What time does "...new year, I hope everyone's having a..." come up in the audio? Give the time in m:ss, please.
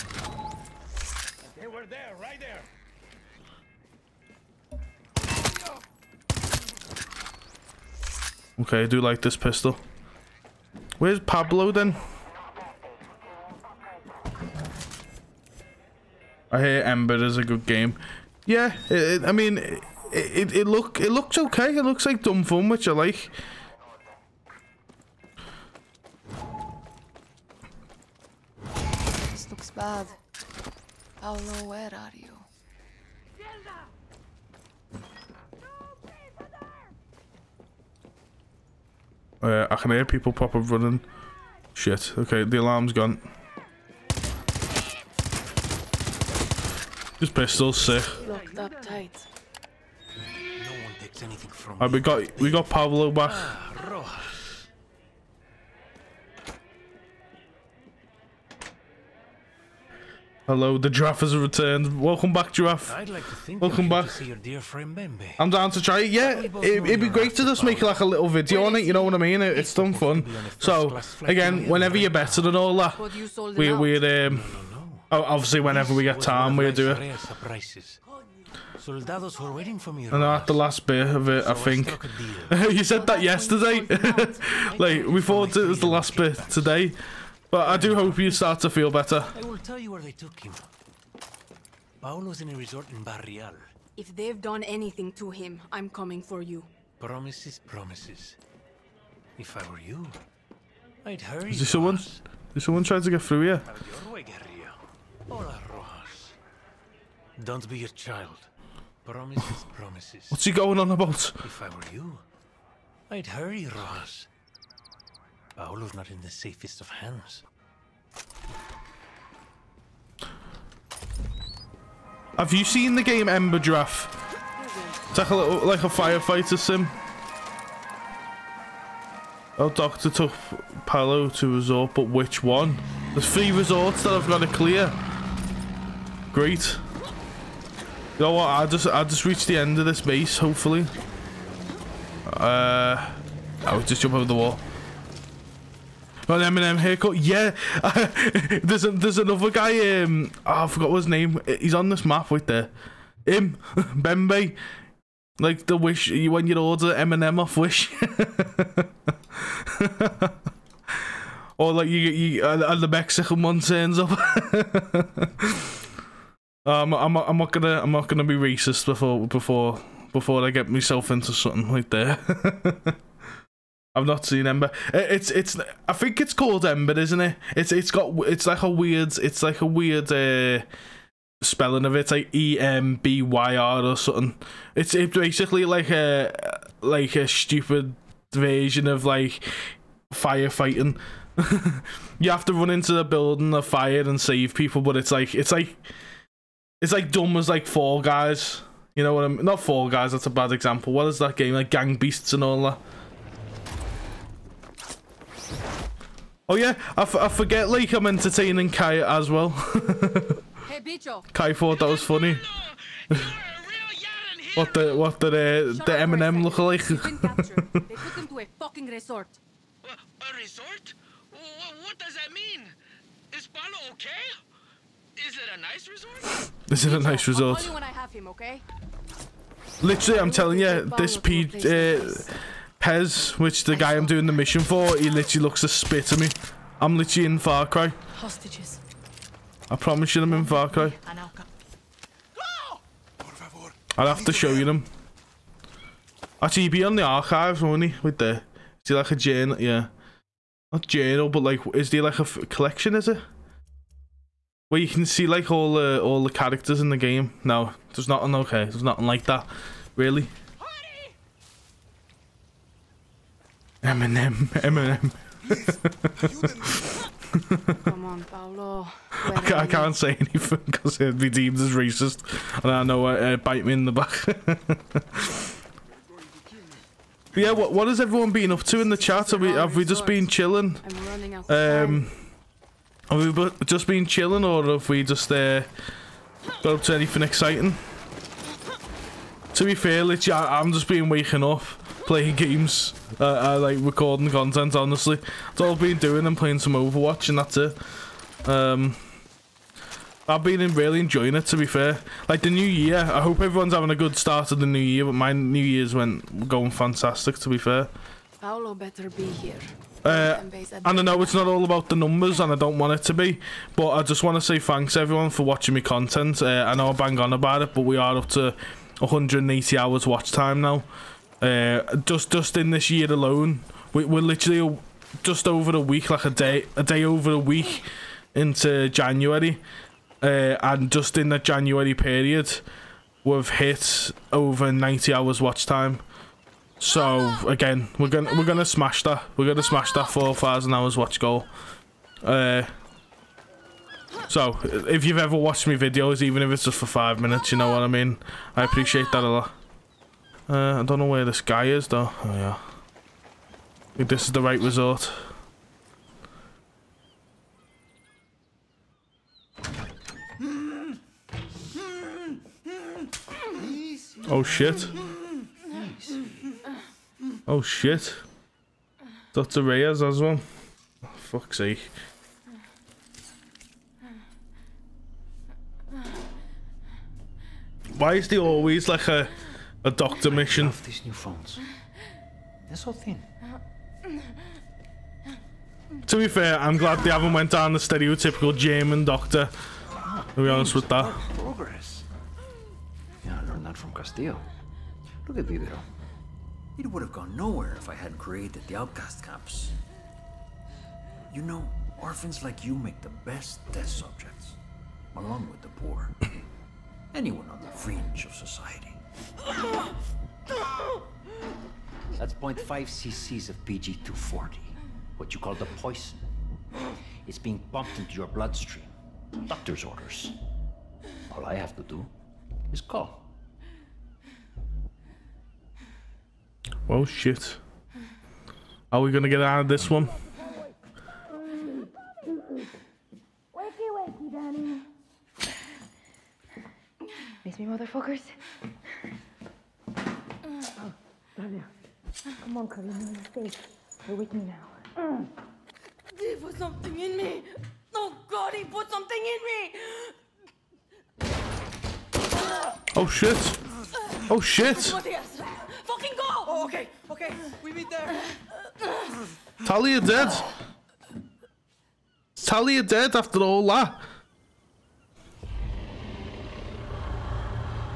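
5:02.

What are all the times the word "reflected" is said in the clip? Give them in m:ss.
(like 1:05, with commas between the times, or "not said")
not said.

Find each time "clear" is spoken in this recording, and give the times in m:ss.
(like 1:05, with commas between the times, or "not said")
2:14.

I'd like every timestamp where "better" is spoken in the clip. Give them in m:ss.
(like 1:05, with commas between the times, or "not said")
1:12, 1:28, 5:08.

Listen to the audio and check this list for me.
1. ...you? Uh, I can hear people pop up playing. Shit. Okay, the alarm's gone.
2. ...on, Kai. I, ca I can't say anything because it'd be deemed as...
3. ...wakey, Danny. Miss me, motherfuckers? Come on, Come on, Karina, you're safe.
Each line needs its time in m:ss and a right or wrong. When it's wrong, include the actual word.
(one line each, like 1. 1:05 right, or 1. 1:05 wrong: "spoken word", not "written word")
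1. 0:32 wrong: "running", not "playing"
2. 4:28 wrong: "Paolo", not "Kai"
3. 7:13 right.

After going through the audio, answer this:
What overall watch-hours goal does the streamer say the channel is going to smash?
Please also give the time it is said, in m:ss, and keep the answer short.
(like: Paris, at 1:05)
4,000 hours, at 5:40.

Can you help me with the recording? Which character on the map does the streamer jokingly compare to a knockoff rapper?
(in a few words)
Bembe.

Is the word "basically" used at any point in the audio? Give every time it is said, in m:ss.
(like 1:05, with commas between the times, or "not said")
3:05.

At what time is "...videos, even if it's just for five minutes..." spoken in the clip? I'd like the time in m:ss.
5:45.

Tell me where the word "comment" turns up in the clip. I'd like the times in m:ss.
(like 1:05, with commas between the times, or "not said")
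not said.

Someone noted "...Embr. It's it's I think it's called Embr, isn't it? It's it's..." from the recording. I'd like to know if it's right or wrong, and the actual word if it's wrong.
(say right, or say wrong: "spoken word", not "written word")
right.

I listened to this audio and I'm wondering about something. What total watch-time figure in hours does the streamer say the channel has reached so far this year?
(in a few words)
180 hours.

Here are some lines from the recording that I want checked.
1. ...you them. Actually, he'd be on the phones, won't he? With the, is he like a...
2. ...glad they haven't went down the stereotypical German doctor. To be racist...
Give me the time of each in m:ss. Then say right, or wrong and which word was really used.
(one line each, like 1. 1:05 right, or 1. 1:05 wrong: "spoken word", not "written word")
1. 4:04 wrong: "archives", not "phones"
2. 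6:26 wrong: "honest", not "racist".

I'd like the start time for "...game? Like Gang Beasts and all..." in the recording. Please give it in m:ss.
3:21.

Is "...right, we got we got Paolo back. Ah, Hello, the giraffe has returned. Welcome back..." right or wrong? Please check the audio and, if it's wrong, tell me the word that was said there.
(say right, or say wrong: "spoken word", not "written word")
right.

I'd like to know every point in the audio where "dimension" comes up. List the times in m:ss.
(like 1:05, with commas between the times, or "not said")
not said.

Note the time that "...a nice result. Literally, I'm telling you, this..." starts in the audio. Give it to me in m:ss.
3:46.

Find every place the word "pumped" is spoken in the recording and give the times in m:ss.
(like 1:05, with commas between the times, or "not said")
6:57.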